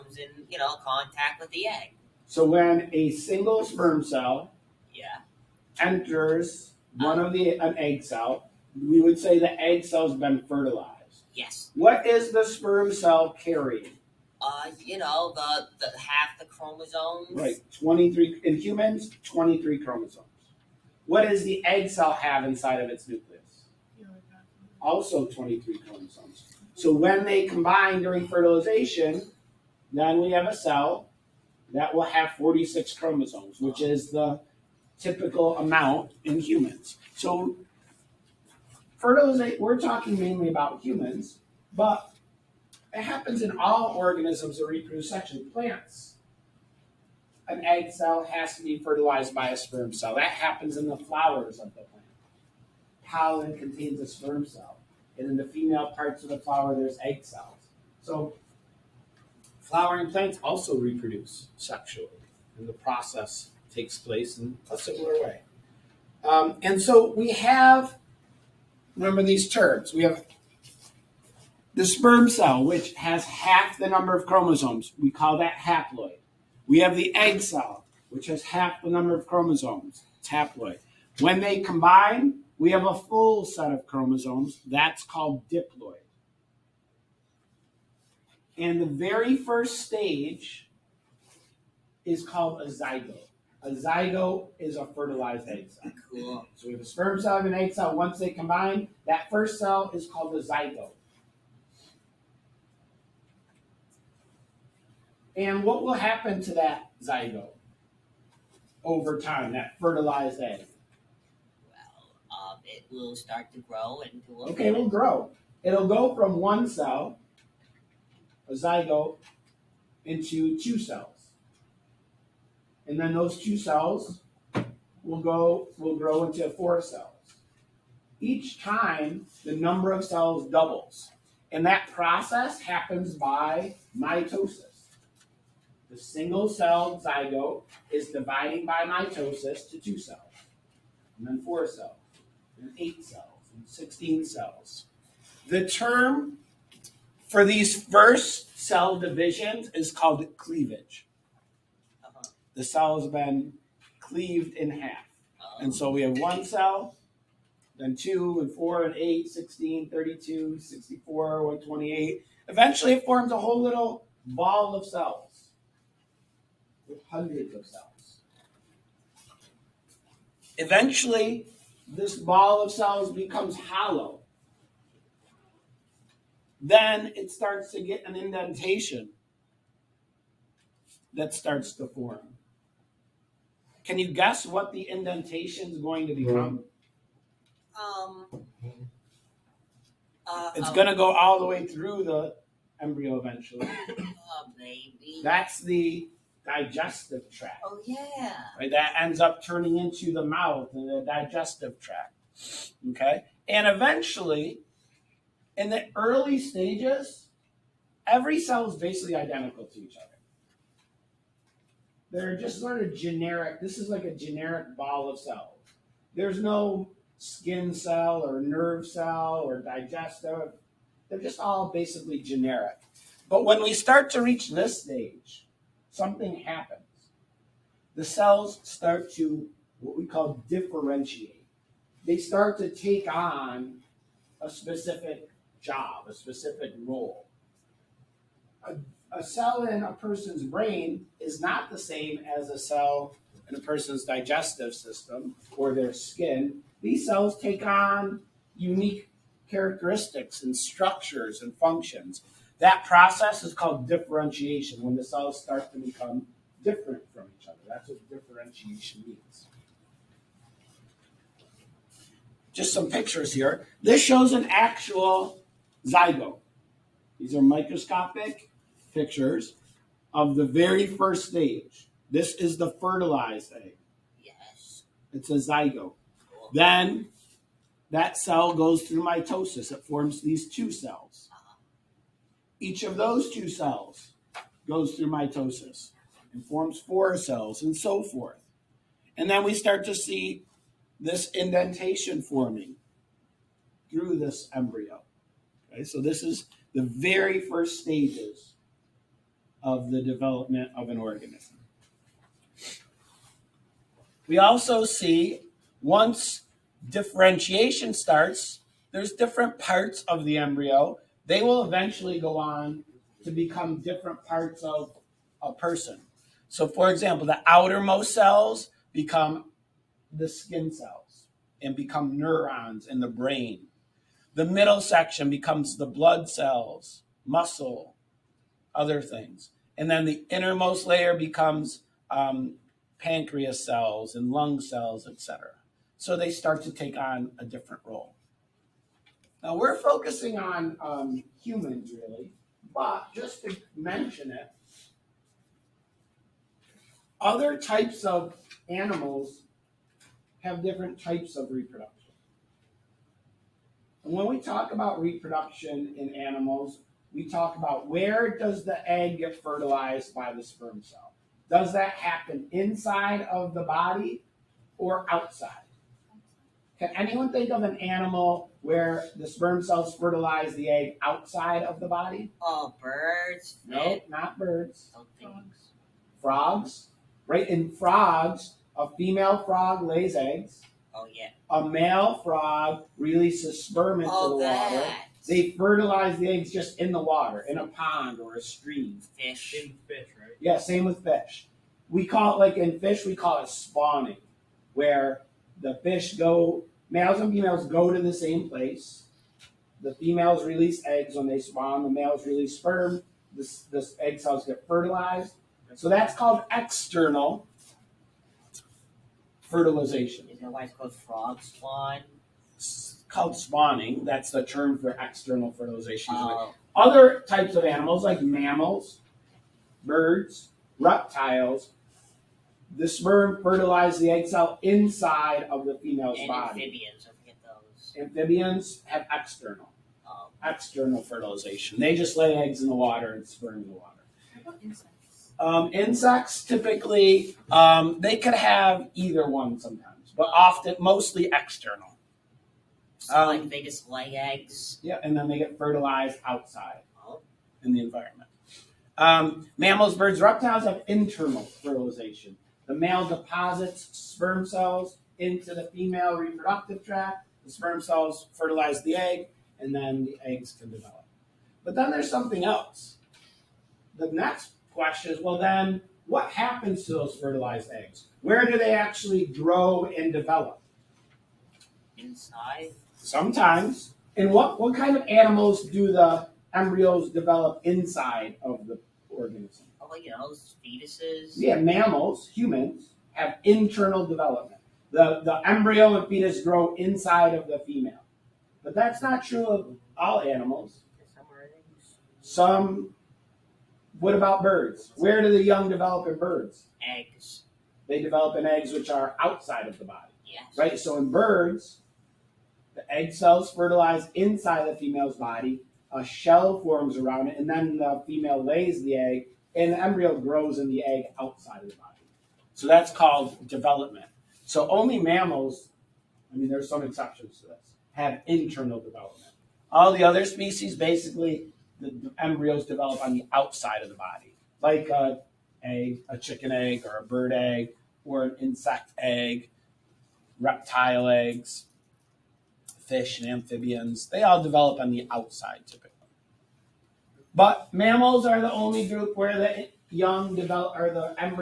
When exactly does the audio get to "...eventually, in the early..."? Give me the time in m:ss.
3:23.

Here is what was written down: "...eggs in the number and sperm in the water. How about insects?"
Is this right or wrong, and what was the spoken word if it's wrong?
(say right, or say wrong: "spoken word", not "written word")
wrong: "water", not "number".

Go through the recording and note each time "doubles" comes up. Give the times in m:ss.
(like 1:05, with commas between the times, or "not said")
2:10.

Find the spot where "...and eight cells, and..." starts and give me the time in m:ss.
2:22.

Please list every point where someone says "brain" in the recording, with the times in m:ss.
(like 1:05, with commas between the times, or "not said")
4:00, 5:23.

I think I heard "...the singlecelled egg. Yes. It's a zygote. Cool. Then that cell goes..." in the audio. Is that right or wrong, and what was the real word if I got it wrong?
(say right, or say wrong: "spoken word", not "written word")
wrong: "fertilized", not "singlecelled".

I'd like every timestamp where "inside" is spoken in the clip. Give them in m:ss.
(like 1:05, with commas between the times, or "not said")
0:22, 6:02, 7:04, 7:51, 7:57, 8:06, 8:24.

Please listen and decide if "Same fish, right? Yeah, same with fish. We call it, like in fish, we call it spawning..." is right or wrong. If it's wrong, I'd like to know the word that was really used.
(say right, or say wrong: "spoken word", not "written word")
right.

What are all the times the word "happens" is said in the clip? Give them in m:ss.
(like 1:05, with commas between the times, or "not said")
0:43, 0:50, 1:45, 2:12, 3:46, 6:01, 7:46.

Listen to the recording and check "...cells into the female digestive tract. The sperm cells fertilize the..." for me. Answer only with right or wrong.
wrong.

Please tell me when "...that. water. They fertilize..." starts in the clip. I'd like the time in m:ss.
6:24.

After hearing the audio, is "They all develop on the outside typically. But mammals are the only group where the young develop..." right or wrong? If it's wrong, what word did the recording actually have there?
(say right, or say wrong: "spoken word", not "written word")
right.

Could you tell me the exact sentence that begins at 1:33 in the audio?
A zygote is a fertilized egg cell.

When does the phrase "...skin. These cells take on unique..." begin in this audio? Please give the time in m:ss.
4:05.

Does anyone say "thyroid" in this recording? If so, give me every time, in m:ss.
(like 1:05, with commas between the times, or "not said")
not said.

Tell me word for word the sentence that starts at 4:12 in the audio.
That process is called differentiation, when the cells start to become different from each other.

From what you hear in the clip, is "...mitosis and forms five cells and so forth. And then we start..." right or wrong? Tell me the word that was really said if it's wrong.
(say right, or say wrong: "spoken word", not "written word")
wrong: "four", not "five".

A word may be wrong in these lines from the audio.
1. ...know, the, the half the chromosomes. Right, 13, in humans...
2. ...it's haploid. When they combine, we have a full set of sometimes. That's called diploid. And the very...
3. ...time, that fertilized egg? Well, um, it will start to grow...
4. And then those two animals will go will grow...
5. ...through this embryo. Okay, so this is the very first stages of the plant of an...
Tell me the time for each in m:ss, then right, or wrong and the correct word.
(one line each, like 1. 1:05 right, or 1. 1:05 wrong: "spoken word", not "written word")
1. 0:14 wrong: "23", not "13"
2. 1:20 wrong: "chromosomes", not "sometimes"
3. 1:49 right
4. 2:02 wrong: "cells", not "animals"
5. 4:53 wrong: "development", not "plant".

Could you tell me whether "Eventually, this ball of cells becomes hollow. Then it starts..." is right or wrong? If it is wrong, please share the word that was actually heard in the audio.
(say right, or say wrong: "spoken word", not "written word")
right.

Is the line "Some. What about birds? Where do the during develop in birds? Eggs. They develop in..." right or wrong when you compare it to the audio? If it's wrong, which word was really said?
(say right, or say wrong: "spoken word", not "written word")
wrong: "young", not "during".